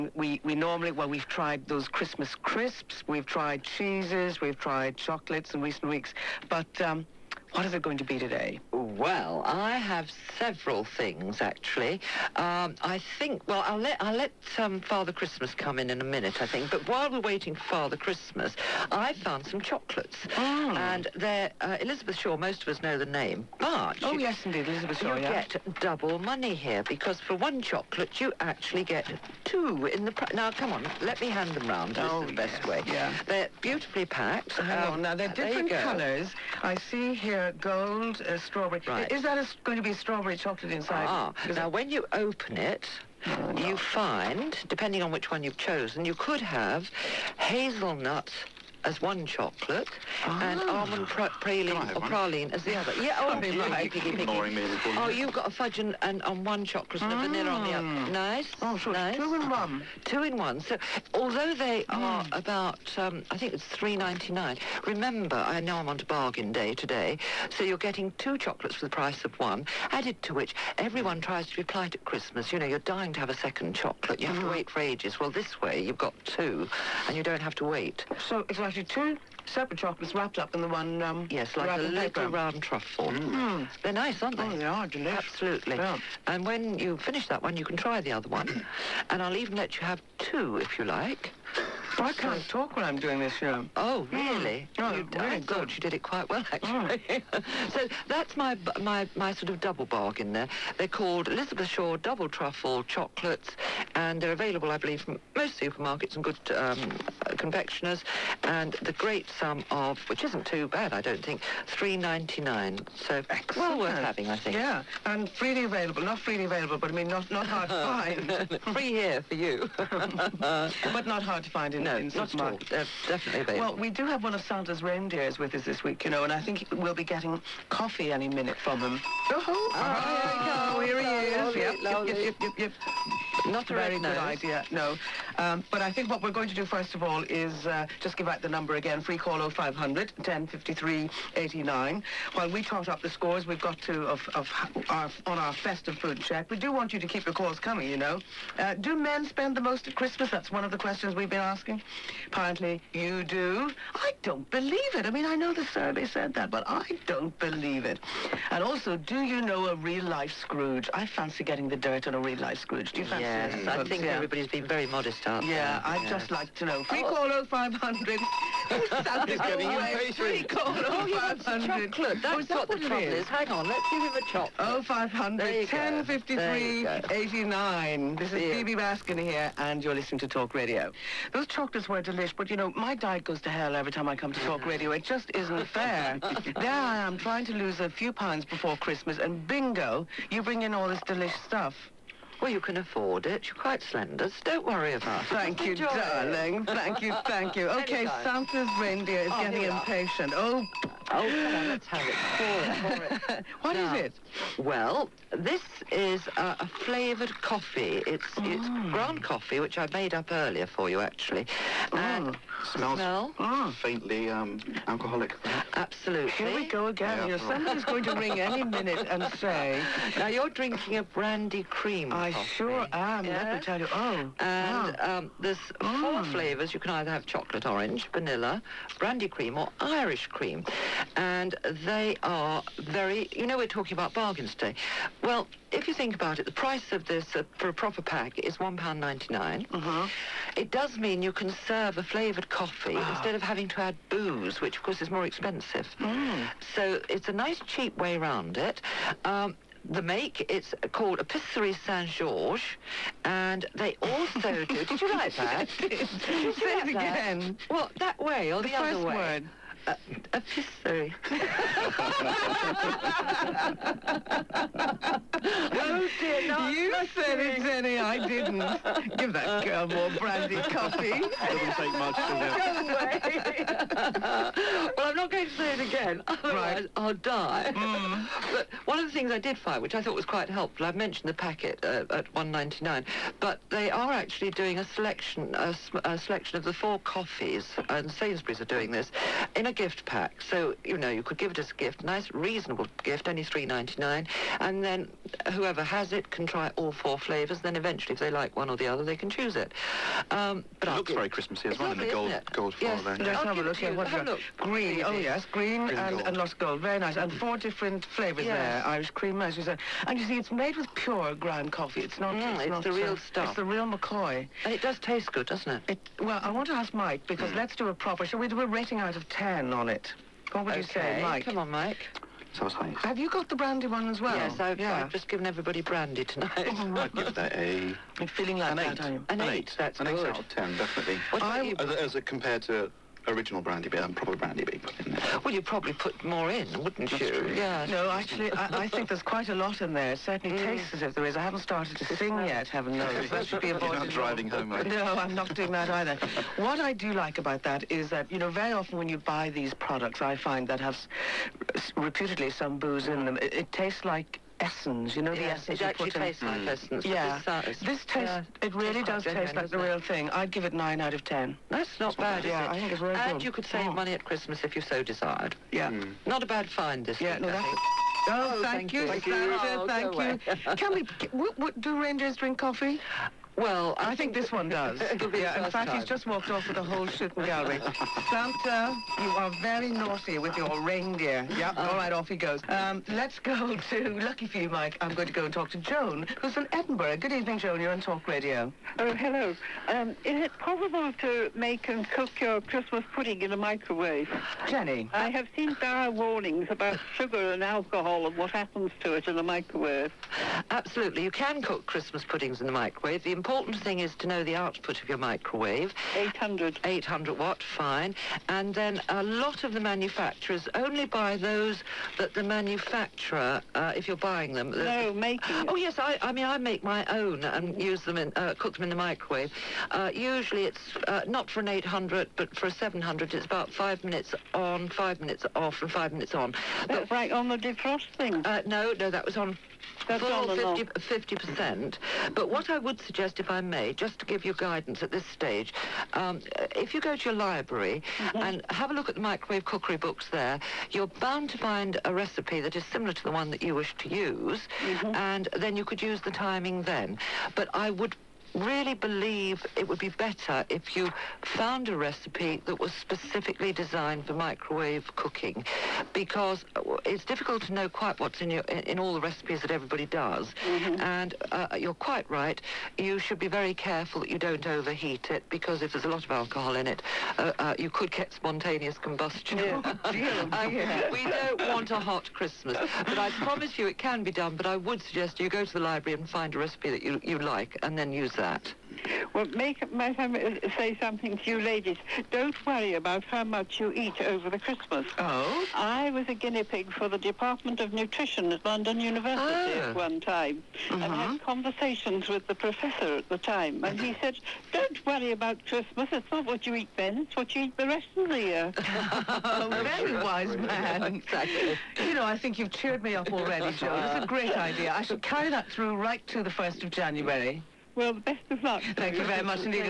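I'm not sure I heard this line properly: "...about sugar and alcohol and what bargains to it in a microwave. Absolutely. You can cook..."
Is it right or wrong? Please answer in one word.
wrong.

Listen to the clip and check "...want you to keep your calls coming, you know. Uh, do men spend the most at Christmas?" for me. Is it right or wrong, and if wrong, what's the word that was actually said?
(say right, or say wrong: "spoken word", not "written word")
right.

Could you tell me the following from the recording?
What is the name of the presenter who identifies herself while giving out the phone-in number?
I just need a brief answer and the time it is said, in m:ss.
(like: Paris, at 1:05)
Bibi Baskin, at 2:58.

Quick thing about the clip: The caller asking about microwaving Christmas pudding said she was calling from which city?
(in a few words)
Edinburgh.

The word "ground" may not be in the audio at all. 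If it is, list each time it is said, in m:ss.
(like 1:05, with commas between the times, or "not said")
3:28, 5:11.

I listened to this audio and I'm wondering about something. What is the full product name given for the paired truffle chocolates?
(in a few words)
Elizabeth Shaw Double Truffle Chocolates.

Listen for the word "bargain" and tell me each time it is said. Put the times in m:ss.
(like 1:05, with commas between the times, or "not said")
1:06, 1:39, 3:54.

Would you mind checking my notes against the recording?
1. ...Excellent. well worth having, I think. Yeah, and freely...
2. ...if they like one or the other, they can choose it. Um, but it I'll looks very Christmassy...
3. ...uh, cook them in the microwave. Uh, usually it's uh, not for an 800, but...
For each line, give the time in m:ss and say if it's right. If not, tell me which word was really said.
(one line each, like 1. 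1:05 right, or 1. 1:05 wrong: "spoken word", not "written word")
1. 1:53 right
2. 4:58 right
3. 6:58 right.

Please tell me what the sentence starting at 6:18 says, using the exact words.
Santa, you are very naughty with your reindeer.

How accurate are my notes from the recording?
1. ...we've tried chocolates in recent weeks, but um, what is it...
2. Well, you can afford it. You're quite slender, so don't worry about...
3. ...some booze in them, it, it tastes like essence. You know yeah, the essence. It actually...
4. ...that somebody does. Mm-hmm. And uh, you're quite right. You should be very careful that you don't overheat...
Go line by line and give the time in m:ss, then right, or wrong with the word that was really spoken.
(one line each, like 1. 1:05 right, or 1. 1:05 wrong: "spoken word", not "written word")
1. 0:04 right
2. 3:12 right
3. 5:52 right
4. 7:39 wrong: "everybody", not "somebody".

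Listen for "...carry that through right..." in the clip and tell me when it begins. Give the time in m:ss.
8:25.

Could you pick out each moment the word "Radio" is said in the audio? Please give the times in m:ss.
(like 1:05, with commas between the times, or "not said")
3:00, 3:04, 6:28.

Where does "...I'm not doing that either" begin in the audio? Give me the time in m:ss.
5:45.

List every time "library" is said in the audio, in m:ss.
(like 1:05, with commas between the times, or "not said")
7:17, 7:55.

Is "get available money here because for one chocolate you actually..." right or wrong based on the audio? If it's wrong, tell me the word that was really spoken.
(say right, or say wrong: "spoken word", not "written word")
wrong: "double", not "available".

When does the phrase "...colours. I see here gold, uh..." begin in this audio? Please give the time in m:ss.
0:35.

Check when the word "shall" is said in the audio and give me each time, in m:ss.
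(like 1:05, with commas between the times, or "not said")
5:18, 8:25.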